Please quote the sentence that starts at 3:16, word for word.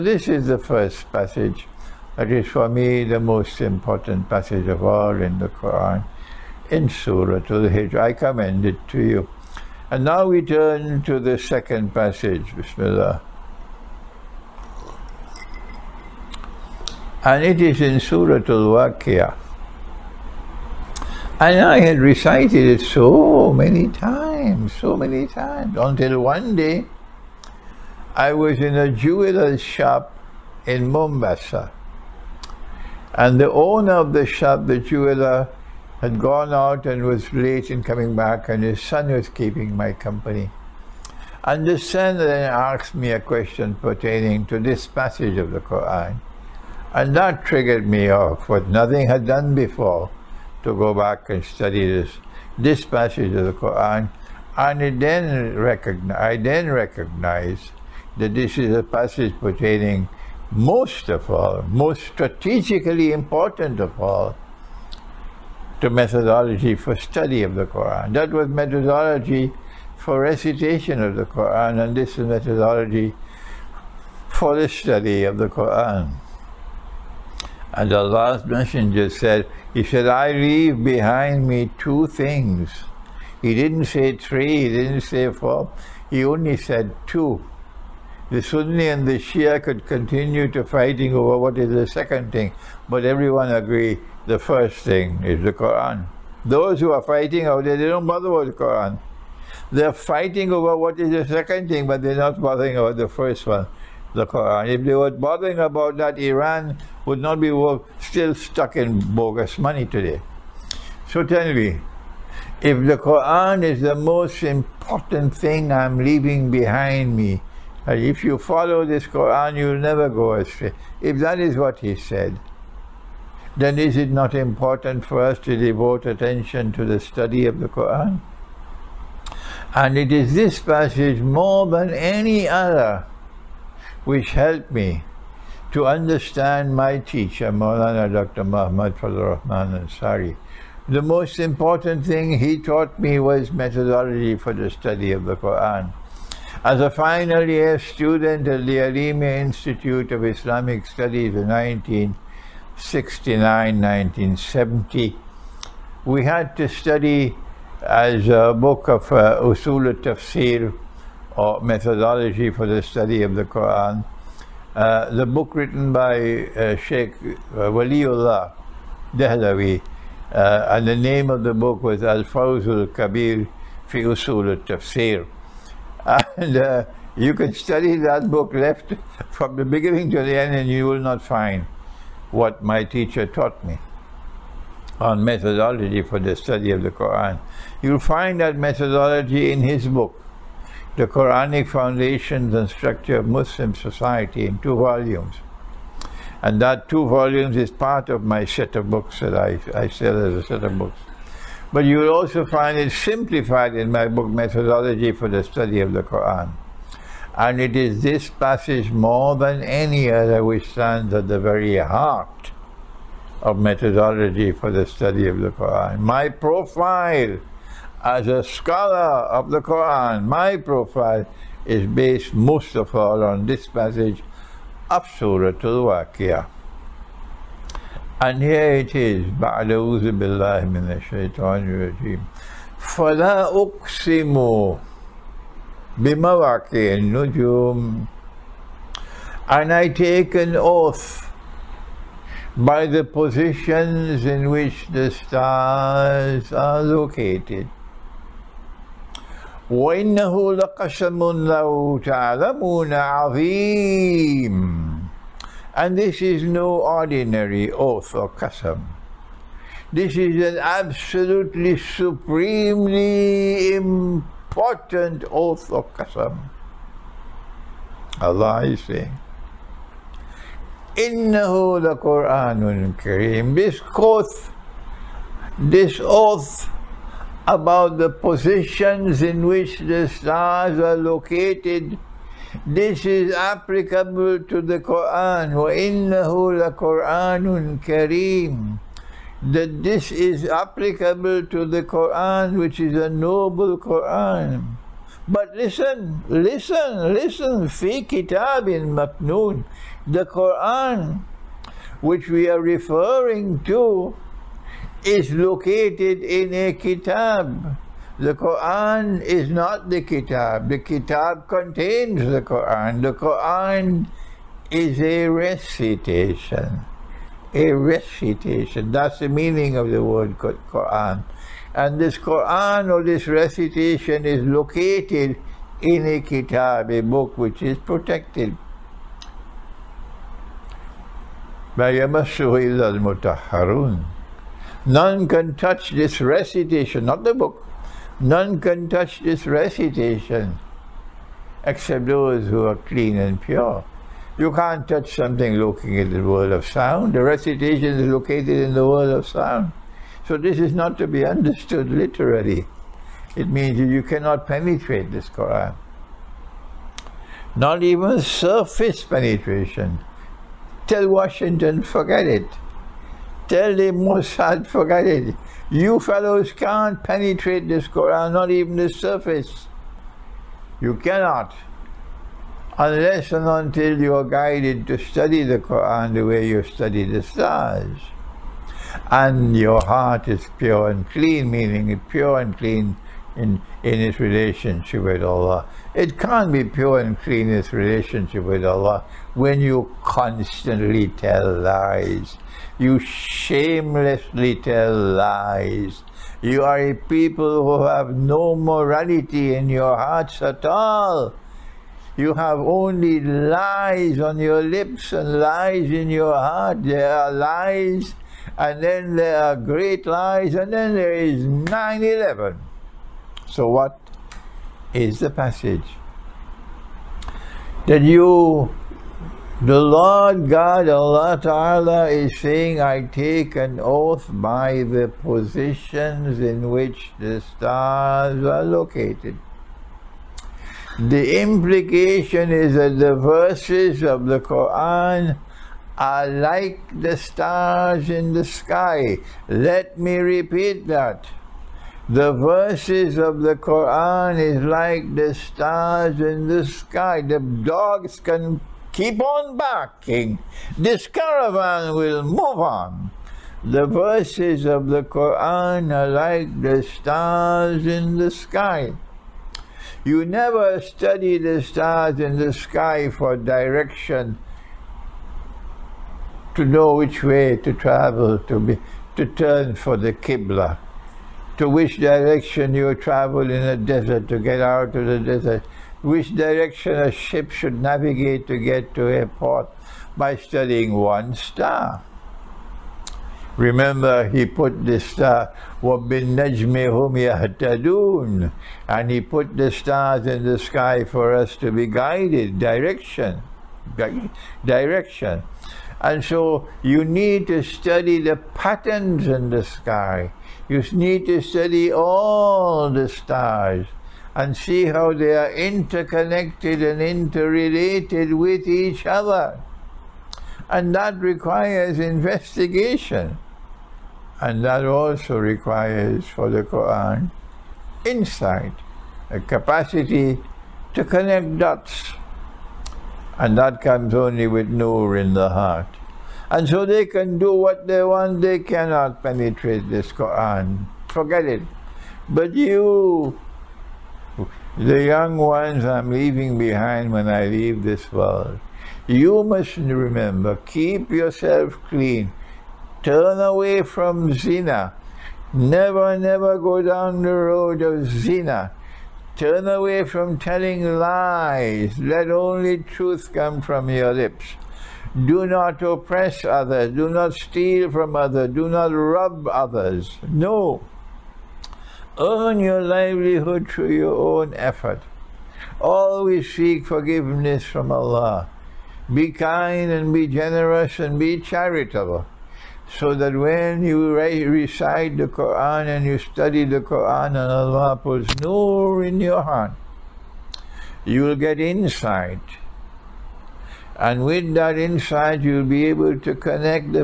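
And that two volumes is part of my set of books that I, I sell as a set of books.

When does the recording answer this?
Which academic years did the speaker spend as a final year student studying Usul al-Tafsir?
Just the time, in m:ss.
2:32.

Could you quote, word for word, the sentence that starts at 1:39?
They're fighting over what is the second thing, but they're not bothering about the first one the Quran.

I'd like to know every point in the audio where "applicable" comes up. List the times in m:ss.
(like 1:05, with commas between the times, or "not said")
4:43, 4:50.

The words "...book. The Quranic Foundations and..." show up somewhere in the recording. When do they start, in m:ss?
3:09.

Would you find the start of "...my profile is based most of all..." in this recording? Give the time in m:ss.
3:40.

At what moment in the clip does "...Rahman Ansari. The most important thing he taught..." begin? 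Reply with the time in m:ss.
2:19.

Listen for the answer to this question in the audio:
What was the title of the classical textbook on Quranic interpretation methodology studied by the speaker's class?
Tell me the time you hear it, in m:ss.
2:52.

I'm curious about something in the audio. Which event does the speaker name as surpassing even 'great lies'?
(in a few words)
9/11.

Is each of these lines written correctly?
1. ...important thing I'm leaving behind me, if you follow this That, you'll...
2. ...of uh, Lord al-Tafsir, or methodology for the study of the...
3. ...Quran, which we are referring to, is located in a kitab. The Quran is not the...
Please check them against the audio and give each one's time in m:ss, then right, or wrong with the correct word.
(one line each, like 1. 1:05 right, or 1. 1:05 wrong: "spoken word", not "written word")
1. 1:54 wrong: "Quran", not "That"
2. 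2:38 wrong: "Usul", not "Lord"
3. 5:00 right.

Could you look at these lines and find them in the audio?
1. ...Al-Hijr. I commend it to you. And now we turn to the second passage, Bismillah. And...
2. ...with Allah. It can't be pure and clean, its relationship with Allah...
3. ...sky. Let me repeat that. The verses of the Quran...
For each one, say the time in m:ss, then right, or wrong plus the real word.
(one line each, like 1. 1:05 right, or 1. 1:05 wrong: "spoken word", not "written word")
1. 0:07 right
2. 6:25 right
3. 7:18 right.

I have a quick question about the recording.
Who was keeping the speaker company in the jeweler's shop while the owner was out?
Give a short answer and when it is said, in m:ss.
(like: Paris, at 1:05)
His son, at 0:38.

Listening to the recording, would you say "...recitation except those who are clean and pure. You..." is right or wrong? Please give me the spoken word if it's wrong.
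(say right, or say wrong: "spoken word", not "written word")
right.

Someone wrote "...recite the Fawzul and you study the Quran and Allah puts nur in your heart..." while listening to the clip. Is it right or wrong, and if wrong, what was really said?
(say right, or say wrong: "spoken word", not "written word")
wrong: "Quran", not "Fawzul".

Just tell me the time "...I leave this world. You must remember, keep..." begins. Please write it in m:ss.
8:57.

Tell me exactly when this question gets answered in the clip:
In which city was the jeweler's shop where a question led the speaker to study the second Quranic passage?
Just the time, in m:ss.
0:30.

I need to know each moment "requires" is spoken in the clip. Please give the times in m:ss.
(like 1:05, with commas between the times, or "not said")
8:31, 8:35.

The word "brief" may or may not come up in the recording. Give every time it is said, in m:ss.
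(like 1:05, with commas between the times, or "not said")
not said.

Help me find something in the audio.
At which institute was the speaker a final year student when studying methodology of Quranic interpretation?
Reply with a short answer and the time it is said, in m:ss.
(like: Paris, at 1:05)
Aleemiyah Institute of Islamic Studies, at 2:28.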